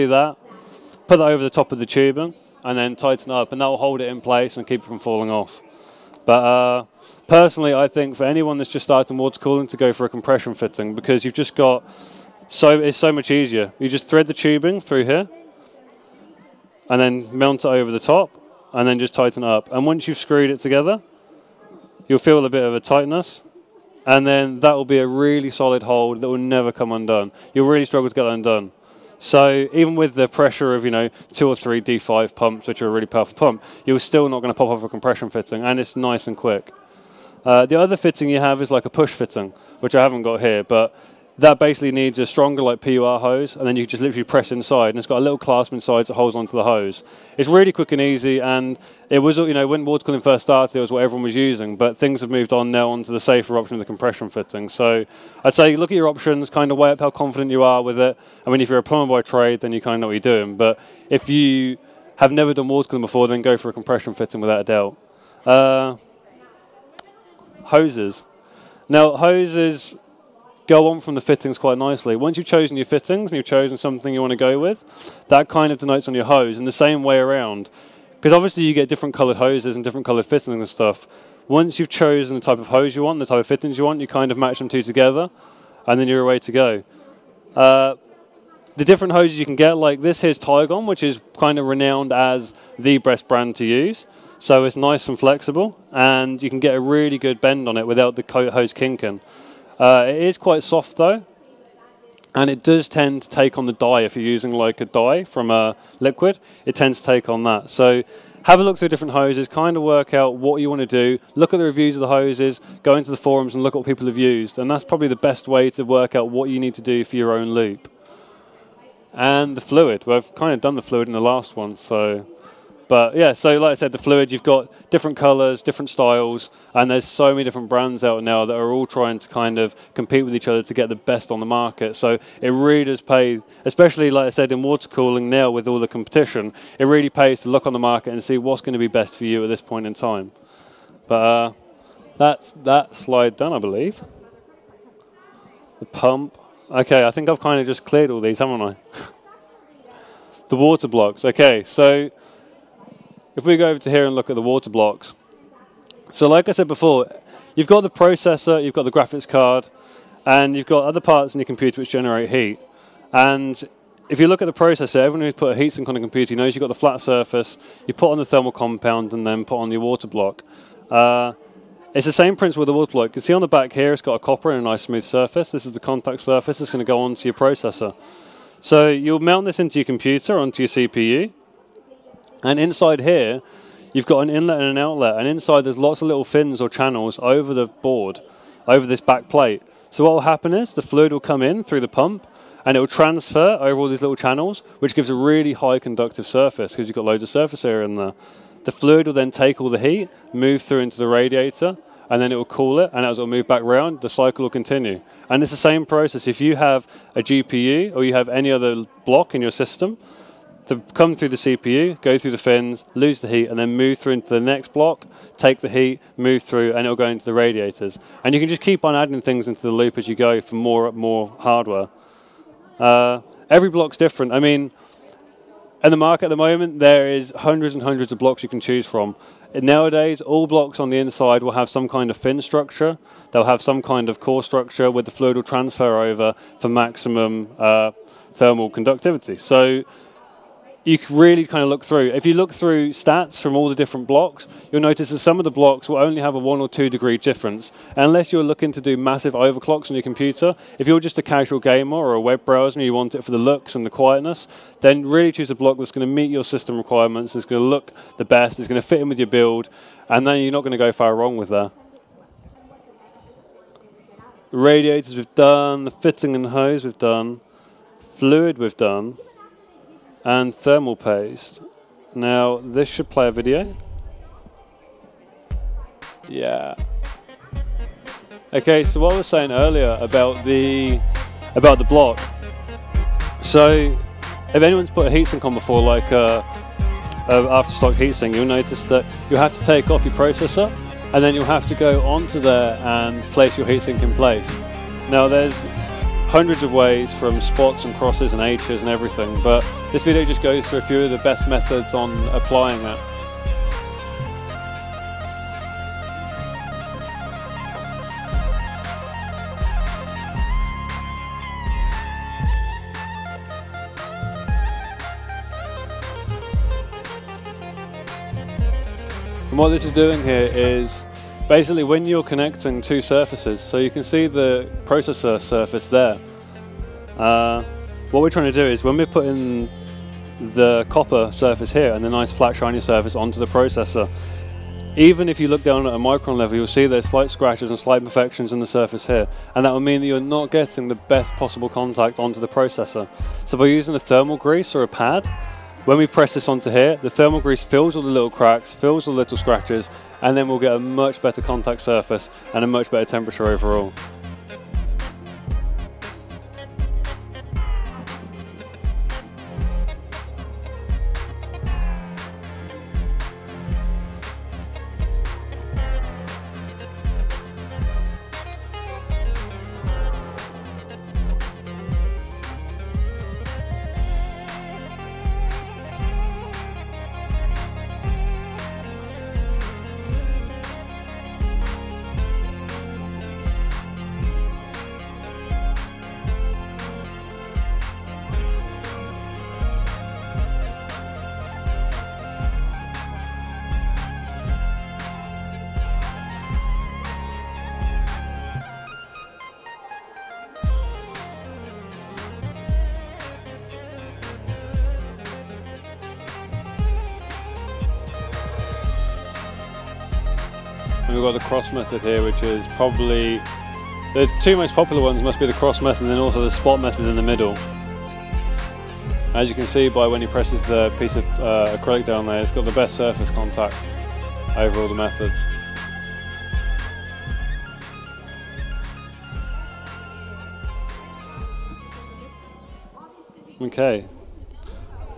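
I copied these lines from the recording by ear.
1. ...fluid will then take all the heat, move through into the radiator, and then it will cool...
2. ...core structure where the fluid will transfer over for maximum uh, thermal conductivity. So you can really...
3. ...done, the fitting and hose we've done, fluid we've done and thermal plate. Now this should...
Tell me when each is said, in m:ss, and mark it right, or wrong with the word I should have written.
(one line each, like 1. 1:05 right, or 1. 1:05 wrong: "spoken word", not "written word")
1. 3:18 right
2. 3:54 right
3. 4:25 wrong: "paste", not "plate".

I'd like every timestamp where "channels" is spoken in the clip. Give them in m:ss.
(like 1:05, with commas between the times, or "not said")
3:06, 3:14.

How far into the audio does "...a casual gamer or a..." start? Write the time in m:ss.
4:11.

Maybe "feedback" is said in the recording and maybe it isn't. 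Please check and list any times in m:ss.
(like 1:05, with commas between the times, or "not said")
not said.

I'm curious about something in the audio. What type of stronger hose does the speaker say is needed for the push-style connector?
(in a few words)
PUR hose.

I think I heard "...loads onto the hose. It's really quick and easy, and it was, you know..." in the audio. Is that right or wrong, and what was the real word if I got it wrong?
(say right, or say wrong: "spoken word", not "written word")
wrong: "holds", not "loads".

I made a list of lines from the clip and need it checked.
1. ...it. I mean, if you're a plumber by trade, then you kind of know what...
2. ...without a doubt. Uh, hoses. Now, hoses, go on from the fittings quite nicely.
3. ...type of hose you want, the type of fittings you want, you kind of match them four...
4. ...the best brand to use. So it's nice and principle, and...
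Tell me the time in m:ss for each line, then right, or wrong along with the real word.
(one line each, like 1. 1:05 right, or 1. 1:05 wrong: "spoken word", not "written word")
1. 0:57 right
2. 1:04 right
3. 1:22 wrong: "two", not "four"
4. 1:32 wrong: "flexible", not "principle".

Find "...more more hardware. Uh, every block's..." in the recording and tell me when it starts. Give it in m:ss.
3:40.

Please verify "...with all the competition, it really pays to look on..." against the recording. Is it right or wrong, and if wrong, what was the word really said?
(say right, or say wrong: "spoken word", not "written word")
right.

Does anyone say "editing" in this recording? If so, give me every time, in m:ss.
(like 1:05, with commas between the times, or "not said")
not said.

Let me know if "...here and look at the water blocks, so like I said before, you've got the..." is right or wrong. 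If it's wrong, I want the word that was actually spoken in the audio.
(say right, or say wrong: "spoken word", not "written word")
right.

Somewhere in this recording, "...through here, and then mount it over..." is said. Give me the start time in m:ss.
0:14.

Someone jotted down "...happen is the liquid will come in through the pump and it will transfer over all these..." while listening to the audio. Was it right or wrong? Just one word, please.
wrong.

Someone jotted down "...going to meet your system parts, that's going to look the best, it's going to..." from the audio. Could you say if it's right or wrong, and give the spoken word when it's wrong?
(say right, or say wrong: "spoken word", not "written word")
wrong: "requirements", not "parts".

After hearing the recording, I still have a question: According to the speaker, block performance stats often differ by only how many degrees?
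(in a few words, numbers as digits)
1 or 2 degrees.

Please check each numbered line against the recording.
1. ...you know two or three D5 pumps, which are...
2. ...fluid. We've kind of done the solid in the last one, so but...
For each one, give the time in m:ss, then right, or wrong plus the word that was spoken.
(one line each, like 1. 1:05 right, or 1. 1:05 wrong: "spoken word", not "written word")
1. 0:30 right
2. 1:59 wrong: "fluid", not "solid".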